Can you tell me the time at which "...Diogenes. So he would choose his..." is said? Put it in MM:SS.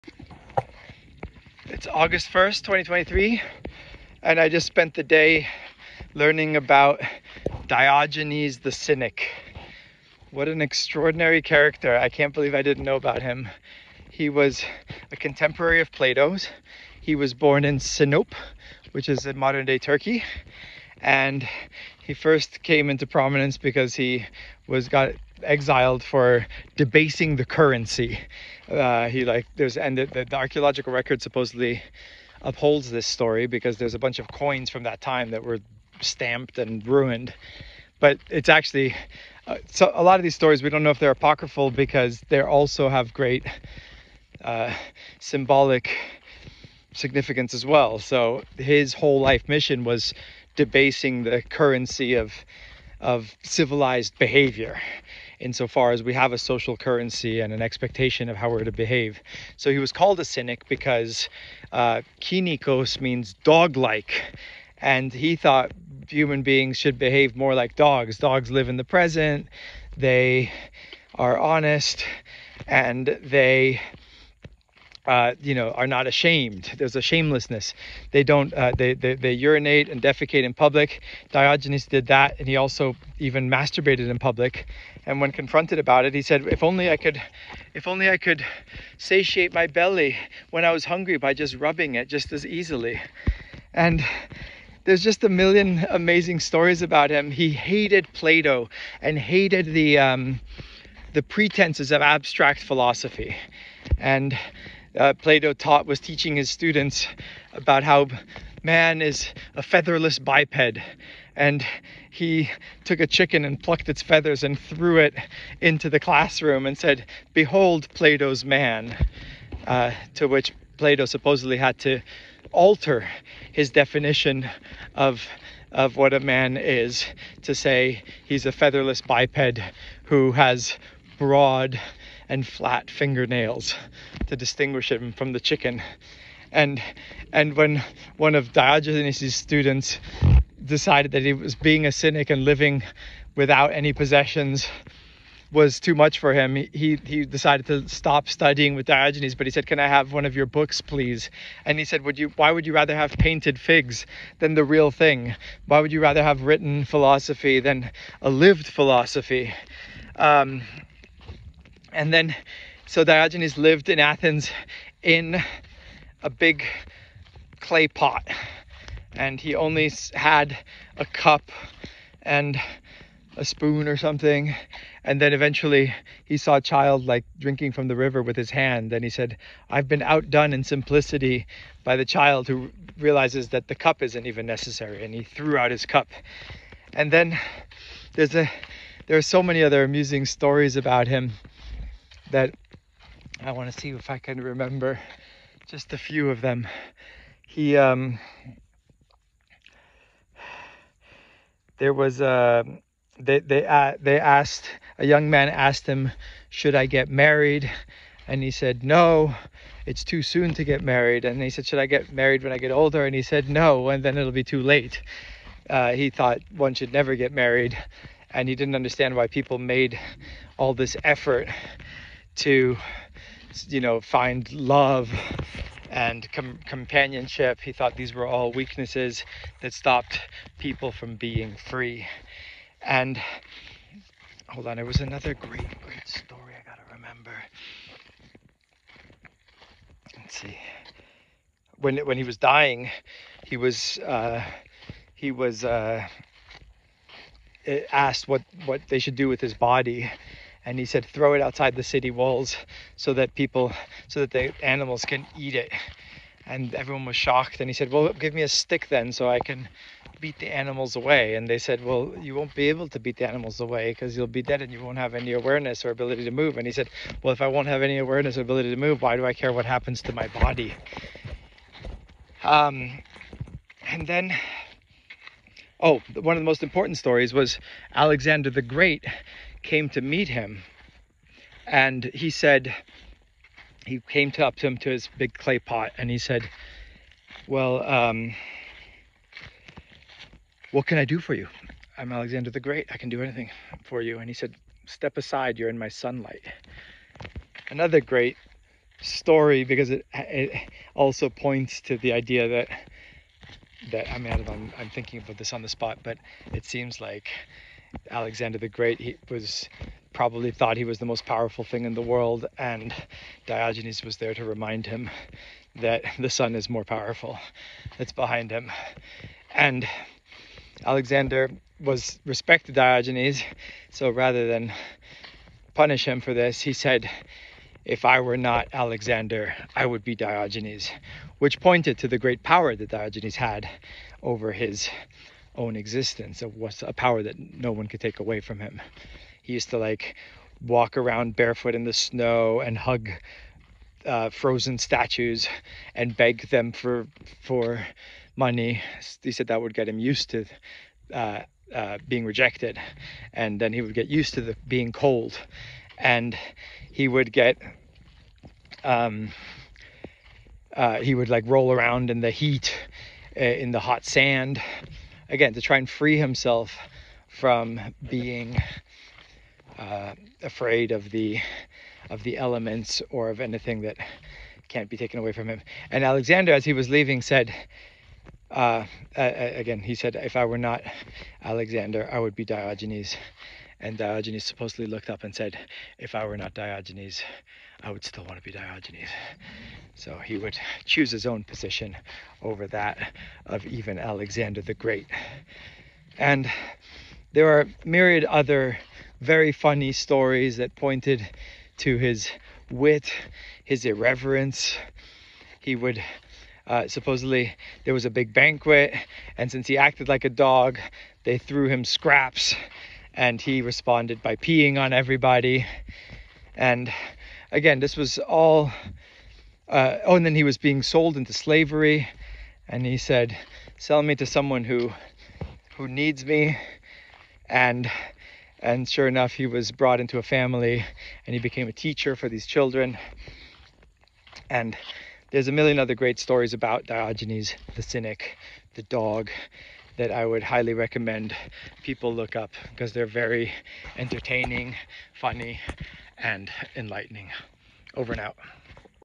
06:28.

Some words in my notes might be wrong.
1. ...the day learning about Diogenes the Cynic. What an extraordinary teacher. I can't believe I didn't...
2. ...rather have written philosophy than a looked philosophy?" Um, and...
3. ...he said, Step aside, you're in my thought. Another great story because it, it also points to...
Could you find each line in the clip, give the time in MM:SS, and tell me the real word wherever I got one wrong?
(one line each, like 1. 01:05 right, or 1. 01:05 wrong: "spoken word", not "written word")
1. 00:04 wrong: "character", not "teacher"
2. 02:35 wrong: "lived", not "looked"
3. 04:54 wrong: "sunlight", not "thought".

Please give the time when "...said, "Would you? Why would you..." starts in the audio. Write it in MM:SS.
02:31.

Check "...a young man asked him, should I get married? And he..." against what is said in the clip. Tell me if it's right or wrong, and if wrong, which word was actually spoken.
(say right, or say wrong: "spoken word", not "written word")
right.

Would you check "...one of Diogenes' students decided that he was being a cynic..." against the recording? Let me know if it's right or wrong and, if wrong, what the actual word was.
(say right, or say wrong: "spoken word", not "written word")
right.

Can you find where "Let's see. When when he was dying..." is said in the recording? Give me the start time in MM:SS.
04:00.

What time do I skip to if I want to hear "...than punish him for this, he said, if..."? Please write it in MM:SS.
05:24.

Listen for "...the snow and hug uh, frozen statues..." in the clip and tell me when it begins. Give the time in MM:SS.
05:41.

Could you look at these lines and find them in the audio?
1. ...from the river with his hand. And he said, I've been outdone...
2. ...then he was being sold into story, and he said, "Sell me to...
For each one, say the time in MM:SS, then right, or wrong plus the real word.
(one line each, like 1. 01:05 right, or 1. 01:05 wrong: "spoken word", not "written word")
1. 02:57 right
2. 07:00 wrong: "slavery", not "story".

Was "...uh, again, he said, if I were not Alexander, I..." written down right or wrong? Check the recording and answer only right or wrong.
right.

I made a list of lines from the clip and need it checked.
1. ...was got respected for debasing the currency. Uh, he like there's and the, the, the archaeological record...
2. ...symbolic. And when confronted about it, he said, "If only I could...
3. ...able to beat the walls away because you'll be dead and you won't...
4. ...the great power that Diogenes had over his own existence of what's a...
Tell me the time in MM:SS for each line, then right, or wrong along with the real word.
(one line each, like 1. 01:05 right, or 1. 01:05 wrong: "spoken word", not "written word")
1. 00:24 wrong: "exiled", not "respected"
2. 01:24 wrong: "public", not "symbolic"
3. 04:22 wrong: "animals", not "walls"
4. 05:32 right.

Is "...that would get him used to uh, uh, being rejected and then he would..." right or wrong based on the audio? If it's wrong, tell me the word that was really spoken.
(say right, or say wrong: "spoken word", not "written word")
right.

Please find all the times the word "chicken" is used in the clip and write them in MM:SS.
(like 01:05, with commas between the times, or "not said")
01:53, 02:15.